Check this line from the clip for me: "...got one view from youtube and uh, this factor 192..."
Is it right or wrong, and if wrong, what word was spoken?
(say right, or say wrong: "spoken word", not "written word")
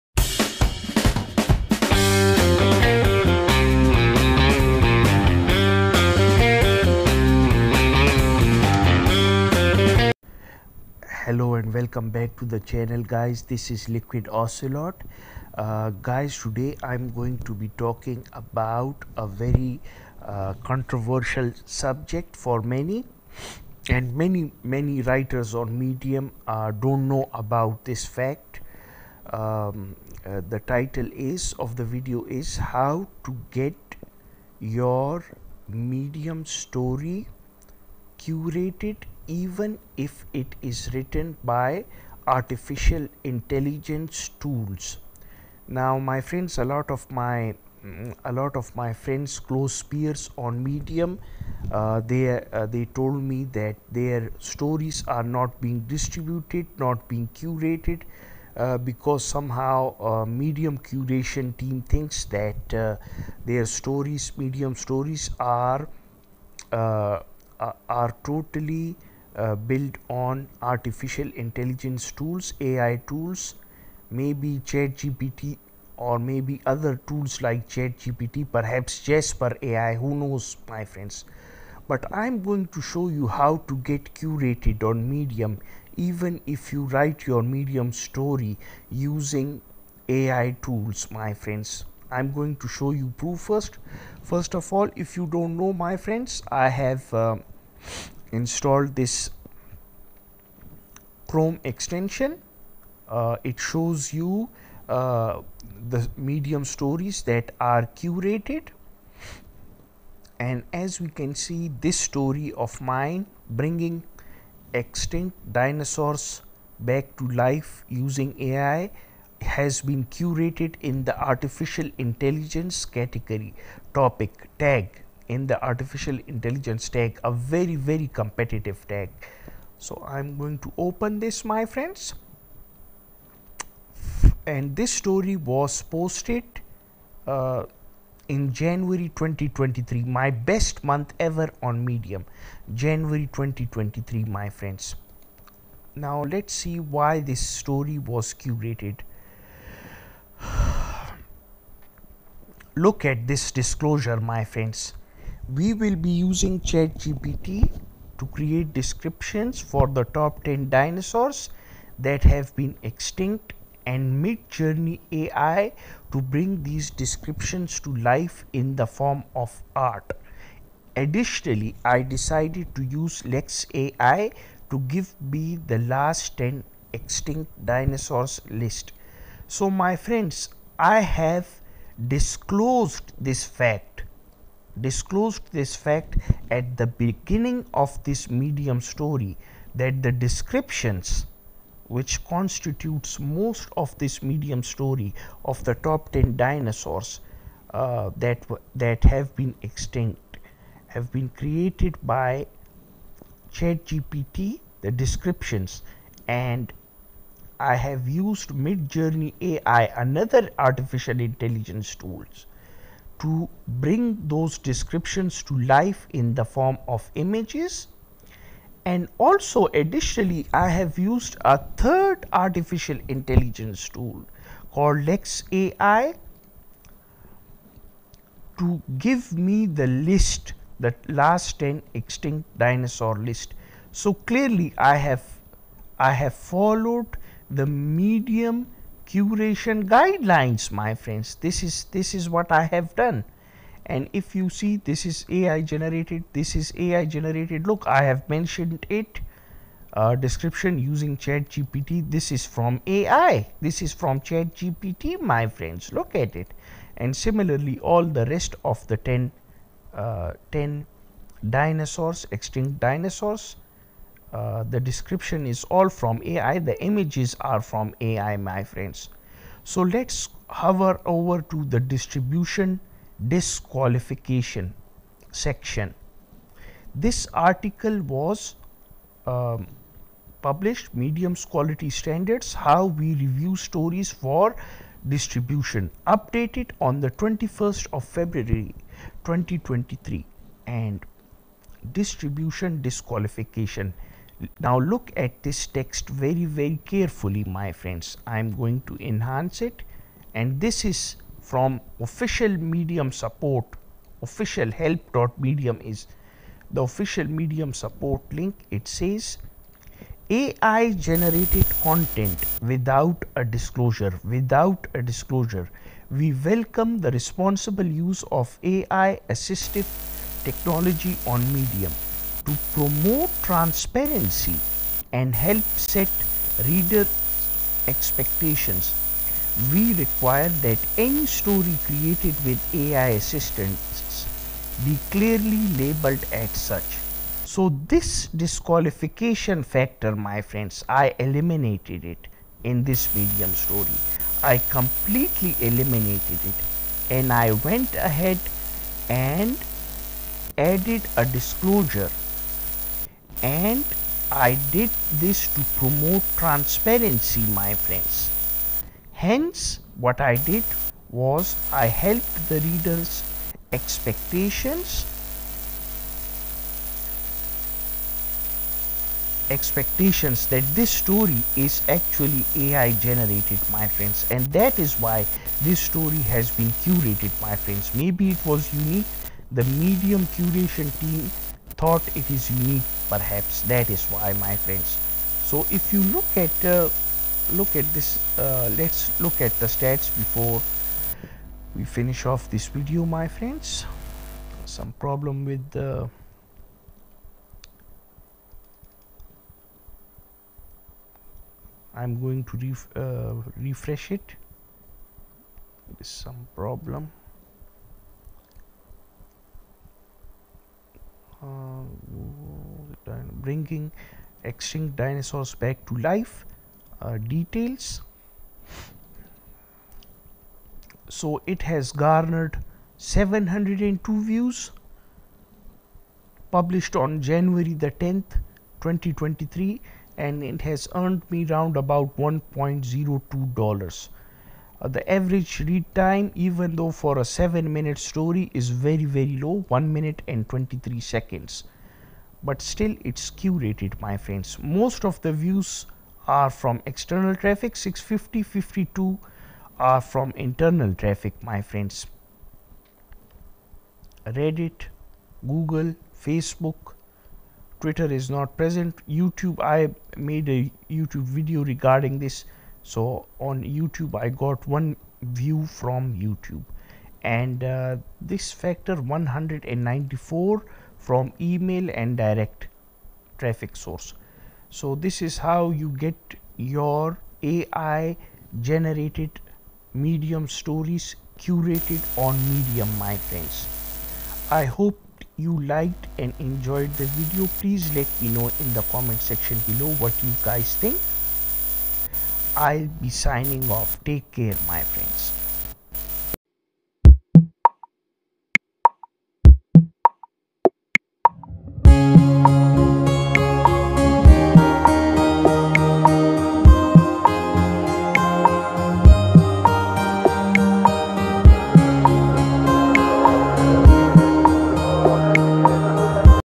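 wrong: "194", not "192".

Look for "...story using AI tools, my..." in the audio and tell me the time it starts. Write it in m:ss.
1:27.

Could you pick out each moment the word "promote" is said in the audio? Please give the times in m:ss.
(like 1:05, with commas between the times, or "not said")
5:22, 5:55.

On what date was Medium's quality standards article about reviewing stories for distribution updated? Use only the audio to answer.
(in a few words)
21 February 2023.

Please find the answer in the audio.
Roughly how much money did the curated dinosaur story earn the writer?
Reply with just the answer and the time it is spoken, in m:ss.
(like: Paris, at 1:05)
$1.02, at 7:12.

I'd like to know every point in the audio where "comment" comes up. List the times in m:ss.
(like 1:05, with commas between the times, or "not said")
8:08.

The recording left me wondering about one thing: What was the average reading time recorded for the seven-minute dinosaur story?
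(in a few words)
1 minute 23 seconds.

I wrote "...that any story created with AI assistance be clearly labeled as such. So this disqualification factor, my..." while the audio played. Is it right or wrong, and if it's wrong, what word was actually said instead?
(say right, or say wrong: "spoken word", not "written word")
right.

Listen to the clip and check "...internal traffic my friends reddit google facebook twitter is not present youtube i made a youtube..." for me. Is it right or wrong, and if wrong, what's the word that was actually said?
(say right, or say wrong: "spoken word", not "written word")
right.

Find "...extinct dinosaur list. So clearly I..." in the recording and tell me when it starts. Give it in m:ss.
3:51.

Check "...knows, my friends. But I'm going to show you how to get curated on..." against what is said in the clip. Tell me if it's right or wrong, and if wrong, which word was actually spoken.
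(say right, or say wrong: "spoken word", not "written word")
right.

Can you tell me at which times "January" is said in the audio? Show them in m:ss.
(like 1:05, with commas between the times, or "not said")
2:18, 2:22, 7:07.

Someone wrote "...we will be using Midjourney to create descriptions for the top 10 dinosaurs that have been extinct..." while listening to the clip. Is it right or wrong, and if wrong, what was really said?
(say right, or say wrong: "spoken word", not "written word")
wrong: "ChatGPT", not "Midjourney".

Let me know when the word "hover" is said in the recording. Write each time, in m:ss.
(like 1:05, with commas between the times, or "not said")
4:30.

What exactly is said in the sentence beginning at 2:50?
Additionally, I decided to use Lex AI to give me the last 10 extinct dinosaurs list.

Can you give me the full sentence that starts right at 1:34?
First of all, if you don't know, my friends, I have.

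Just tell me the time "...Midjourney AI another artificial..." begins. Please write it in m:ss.
3:28.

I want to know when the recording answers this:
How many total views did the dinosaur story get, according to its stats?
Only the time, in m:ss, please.
7:02.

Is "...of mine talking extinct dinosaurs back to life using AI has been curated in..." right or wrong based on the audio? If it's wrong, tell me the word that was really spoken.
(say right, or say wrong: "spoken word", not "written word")
wrong: "bringing", not "talking".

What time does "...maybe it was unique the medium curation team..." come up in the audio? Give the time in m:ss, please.
6:17.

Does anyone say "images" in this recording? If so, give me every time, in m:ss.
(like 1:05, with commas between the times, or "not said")
3:37, 4:26.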